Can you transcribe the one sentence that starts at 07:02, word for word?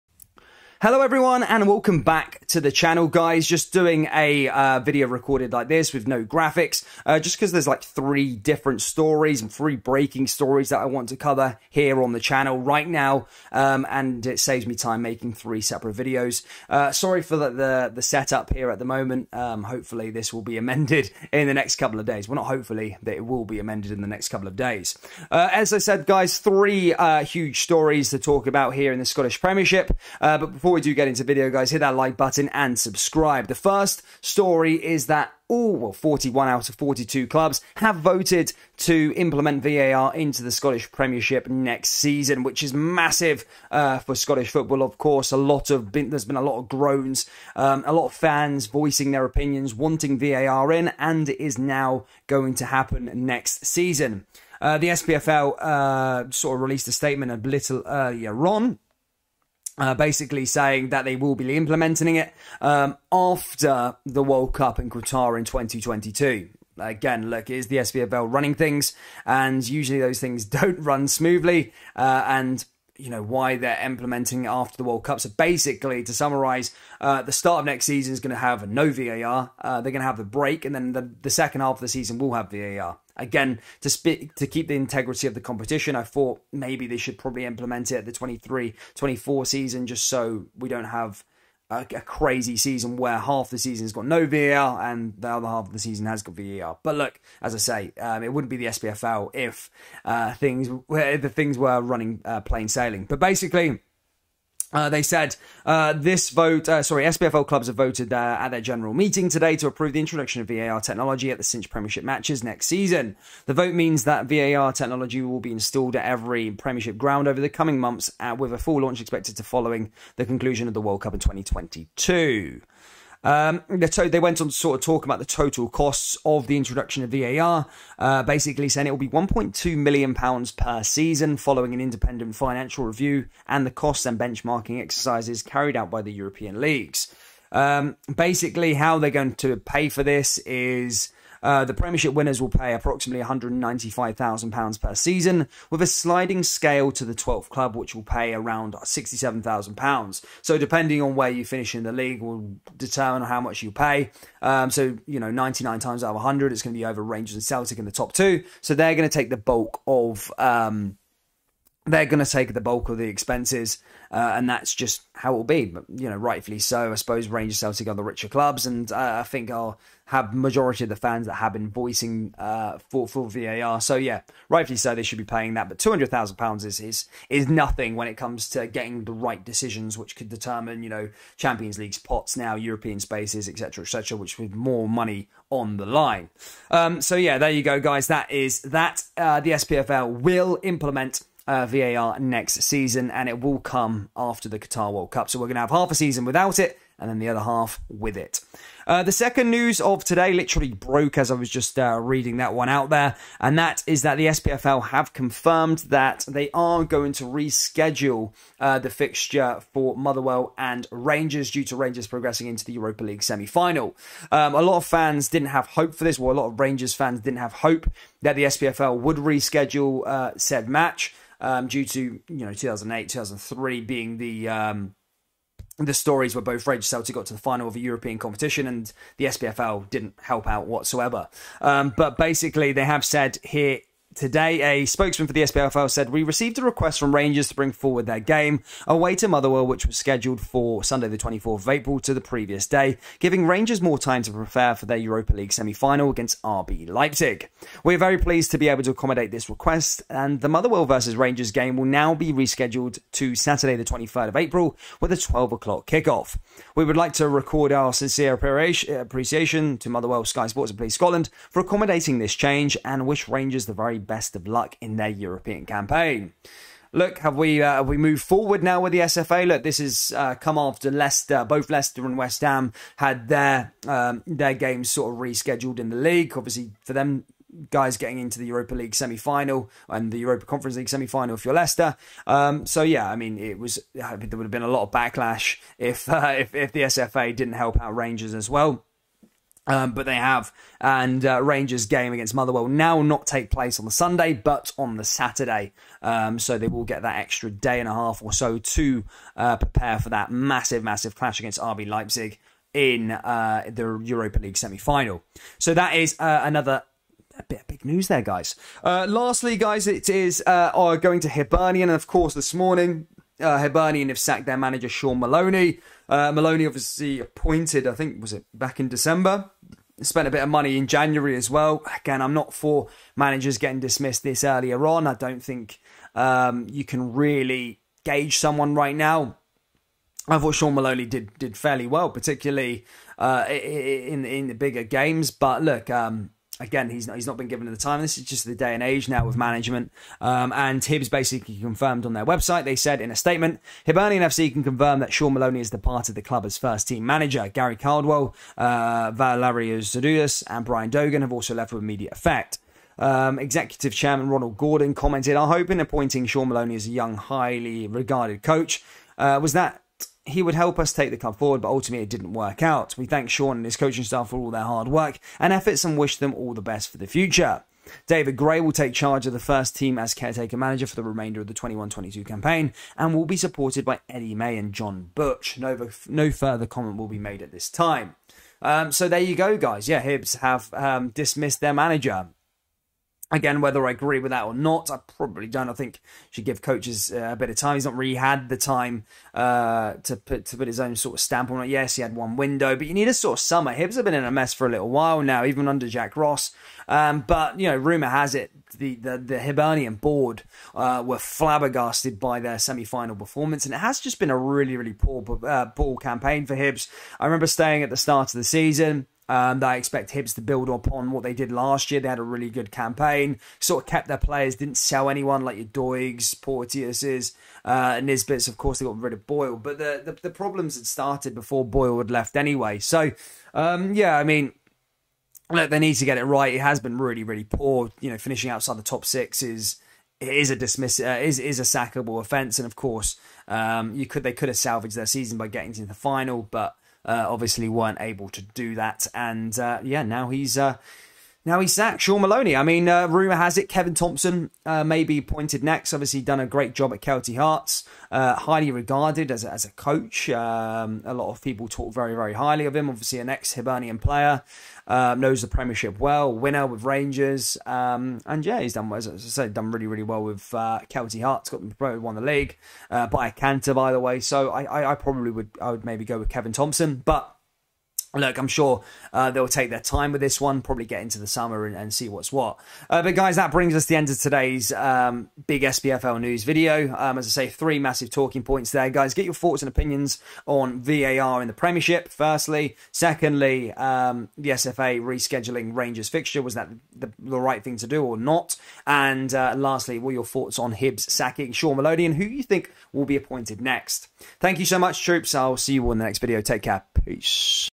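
So, um, yeah, I mean, look, they need to get it right.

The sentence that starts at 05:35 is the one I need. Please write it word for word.
But look, um, again, he's not, he's not been given the time.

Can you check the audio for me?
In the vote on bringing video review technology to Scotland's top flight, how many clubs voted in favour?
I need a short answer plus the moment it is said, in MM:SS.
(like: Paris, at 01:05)
41, at 00:35.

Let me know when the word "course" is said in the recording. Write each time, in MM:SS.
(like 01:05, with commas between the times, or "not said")
00:44, 05:12, 06:58, 07:12.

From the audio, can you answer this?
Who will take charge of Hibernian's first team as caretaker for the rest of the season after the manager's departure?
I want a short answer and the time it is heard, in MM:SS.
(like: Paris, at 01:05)
David Gray, at 06:08.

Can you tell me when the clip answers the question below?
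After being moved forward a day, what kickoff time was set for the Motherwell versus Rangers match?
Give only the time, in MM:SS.
04:15.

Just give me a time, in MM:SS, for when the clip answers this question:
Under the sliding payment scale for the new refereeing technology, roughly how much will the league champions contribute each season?
02:23.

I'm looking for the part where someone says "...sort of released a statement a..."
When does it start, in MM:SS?
00:56.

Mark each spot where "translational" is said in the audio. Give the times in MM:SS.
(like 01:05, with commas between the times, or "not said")
not said.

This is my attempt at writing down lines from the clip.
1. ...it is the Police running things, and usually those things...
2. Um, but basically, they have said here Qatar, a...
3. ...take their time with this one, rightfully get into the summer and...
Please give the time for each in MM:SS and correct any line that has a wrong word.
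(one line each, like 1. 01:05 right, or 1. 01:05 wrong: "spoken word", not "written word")
1. 01:07 wrong: "SPFL", not "Police"
2. 03:51 wrong: "Today", not "Qatar"
3. 07:49 wrong: "probably", not "rightfully".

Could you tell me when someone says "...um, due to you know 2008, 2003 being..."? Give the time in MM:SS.
03:41.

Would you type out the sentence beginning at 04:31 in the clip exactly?
Both Leicester and West Ham had their um, their games sort of rescheduled in the league.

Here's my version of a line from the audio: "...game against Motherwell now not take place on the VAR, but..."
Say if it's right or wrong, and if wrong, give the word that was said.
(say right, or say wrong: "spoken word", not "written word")
wrong: "Sunday", not "VAR".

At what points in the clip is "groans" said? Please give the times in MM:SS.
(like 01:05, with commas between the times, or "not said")
00:46.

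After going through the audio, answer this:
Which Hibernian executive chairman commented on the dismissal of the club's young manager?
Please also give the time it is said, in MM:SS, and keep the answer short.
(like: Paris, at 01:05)
Ronald Gordon, at 05:54.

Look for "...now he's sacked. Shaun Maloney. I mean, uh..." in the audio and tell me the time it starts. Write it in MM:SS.
07:21.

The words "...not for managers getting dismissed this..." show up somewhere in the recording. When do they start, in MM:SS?
05:22.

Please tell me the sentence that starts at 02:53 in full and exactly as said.
So yeah, rightfully so, they should be paying that.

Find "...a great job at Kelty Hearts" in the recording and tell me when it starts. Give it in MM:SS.
07:26.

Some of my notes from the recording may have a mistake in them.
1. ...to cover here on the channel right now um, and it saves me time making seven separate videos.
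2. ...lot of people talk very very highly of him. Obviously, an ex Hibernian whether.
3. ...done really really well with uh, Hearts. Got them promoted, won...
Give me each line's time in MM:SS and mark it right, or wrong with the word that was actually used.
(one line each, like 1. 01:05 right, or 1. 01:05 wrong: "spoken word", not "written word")
1. 00:11 wrong: "three", not "seven"
2. 07:31 wrong: "player", not "whether"
3. 07:39 right.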